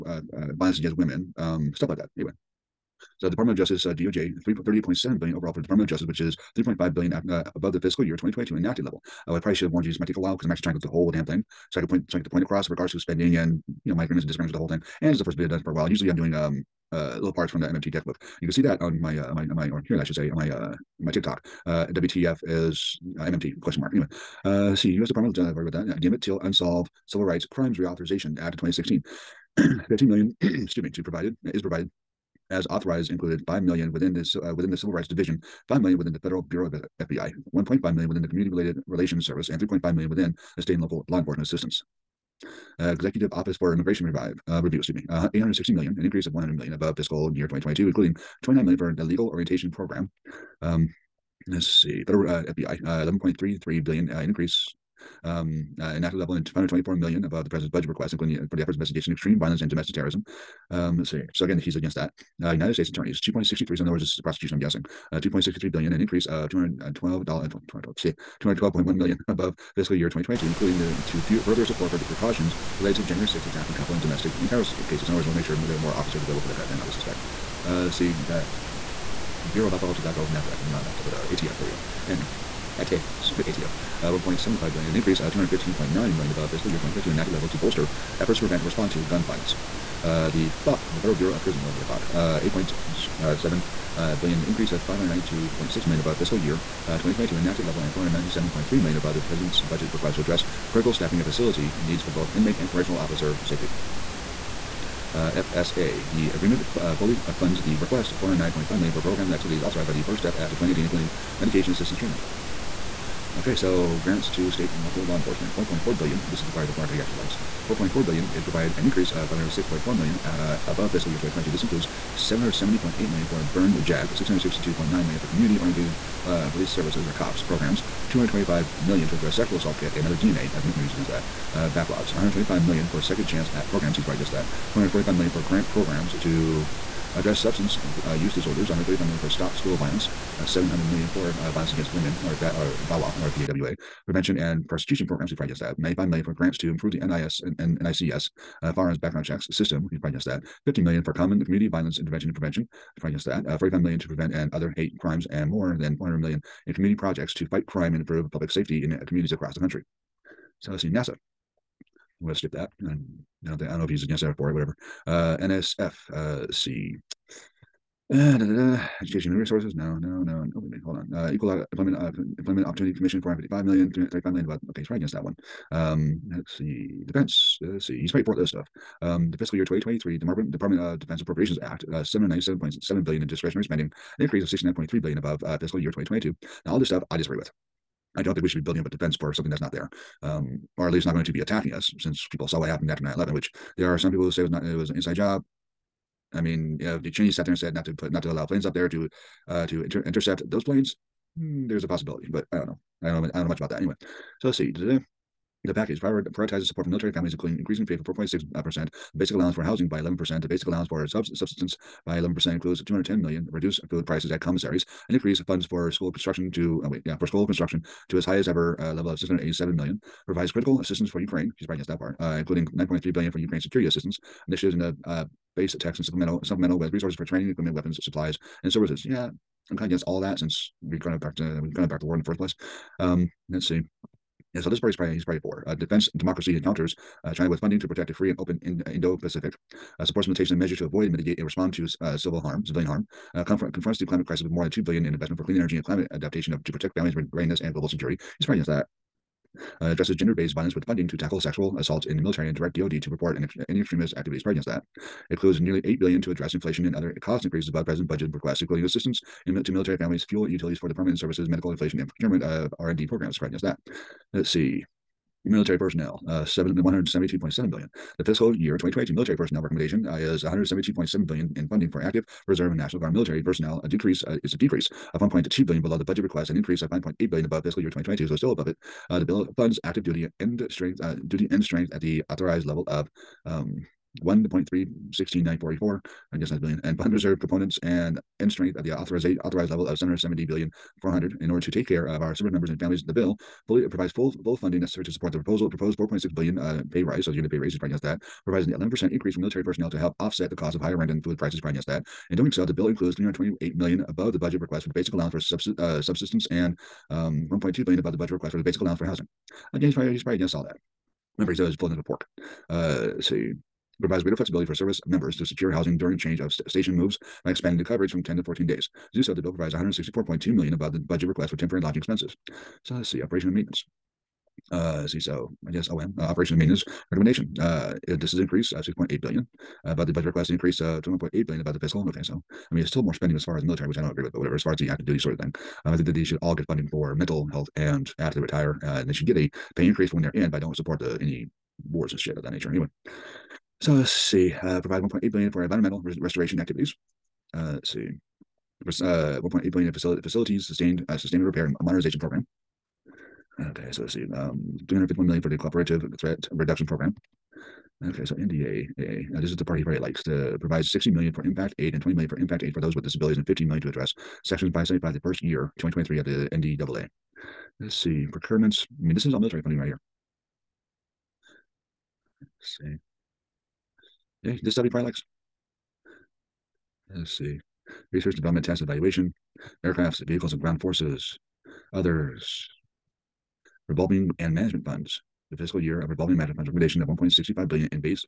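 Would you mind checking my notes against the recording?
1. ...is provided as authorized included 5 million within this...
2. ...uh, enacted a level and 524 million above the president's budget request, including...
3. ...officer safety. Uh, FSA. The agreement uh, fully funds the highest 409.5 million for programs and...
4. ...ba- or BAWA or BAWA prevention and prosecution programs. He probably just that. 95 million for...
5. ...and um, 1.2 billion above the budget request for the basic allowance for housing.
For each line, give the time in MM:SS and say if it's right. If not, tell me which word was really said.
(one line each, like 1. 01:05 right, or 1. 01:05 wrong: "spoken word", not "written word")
1. 00:31 right
2. 00:55 right
3. 01:42 wrong: "request", not "highest"
4. 02:22 right
5. 05:06 right.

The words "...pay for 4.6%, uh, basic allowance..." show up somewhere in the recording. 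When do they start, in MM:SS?
03:27.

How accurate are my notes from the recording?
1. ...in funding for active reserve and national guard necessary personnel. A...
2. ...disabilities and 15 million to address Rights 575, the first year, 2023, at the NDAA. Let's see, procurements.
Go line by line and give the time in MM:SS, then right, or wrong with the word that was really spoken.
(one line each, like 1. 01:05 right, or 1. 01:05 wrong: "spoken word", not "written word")
1. 04:31 wrong: "military", not "necessary"
2. 06:03 wrong: "Section", not "Rights".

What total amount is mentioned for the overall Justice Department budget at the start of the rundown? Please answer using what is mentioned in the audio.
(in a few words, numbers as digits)
$38.7 billion.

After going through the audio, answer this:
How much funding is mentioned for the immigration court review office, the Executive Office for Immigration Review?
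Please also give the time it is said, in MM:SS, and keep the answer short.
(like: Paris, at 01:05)
$860 million, at 00:45.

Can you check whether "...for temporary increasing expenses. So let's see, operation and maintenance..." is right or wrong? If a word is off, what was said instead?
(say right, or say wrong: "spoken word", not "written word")
wrong: "lodging", not "increasing".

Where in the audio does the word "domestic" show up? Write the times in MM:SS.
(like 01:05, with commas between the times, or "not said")
00:59, 01:14.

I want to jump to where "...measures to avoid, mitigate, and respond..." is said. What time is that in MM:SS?
04:00.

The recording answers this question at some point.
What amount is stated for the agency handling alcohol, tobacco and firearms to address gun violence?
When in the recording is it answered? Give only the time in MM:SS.
01:24.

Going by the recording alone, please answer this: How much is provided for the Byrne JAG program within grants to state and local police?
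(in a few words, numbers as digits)
$770.8 million.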